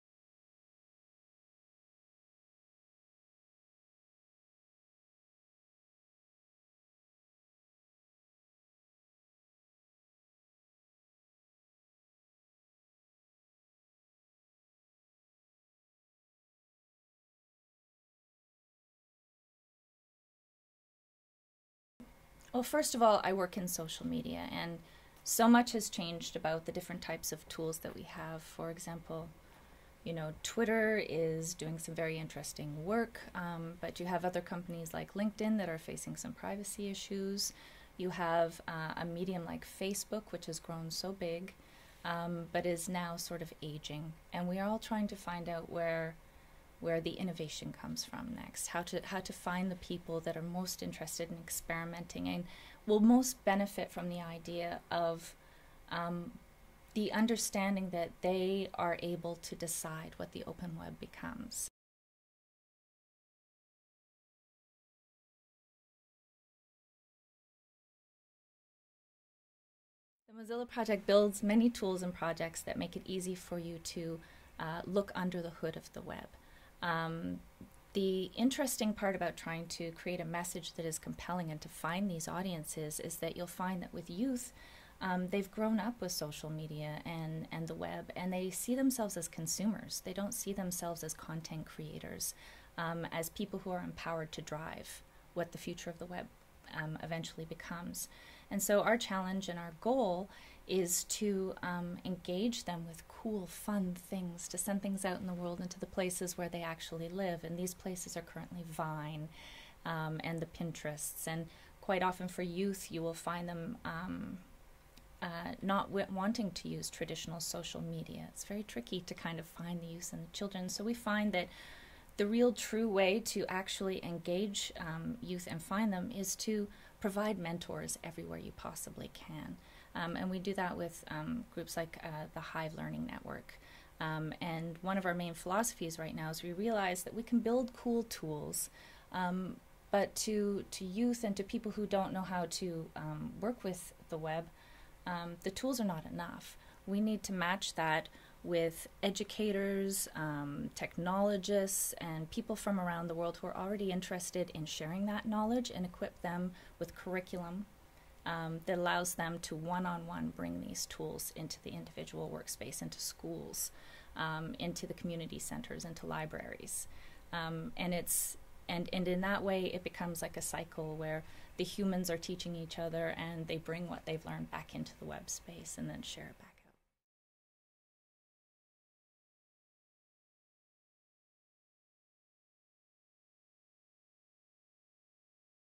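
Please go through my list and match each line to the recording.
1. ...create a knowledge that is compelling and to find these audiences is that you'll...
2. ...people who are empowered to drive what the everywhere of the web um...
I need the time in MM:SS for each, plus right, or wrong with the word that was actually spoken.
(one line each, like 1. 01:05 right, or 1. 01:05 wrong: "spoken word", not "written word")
1. 01:19 wrong: "message", not "knowledge"
2. 01:33 wrong: "future", not "everywhere".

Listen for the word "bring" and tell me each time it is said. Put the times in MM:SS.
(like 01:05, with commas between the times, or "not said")
02:40, 02:53.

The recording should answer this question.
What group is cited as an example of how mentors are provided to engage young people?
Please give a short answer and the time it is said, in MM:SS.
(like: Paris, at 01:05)
Hive Learning Network, at 02:12.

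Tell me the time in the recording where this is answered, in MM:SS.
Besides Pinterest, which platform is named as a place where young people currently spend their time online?
01:48.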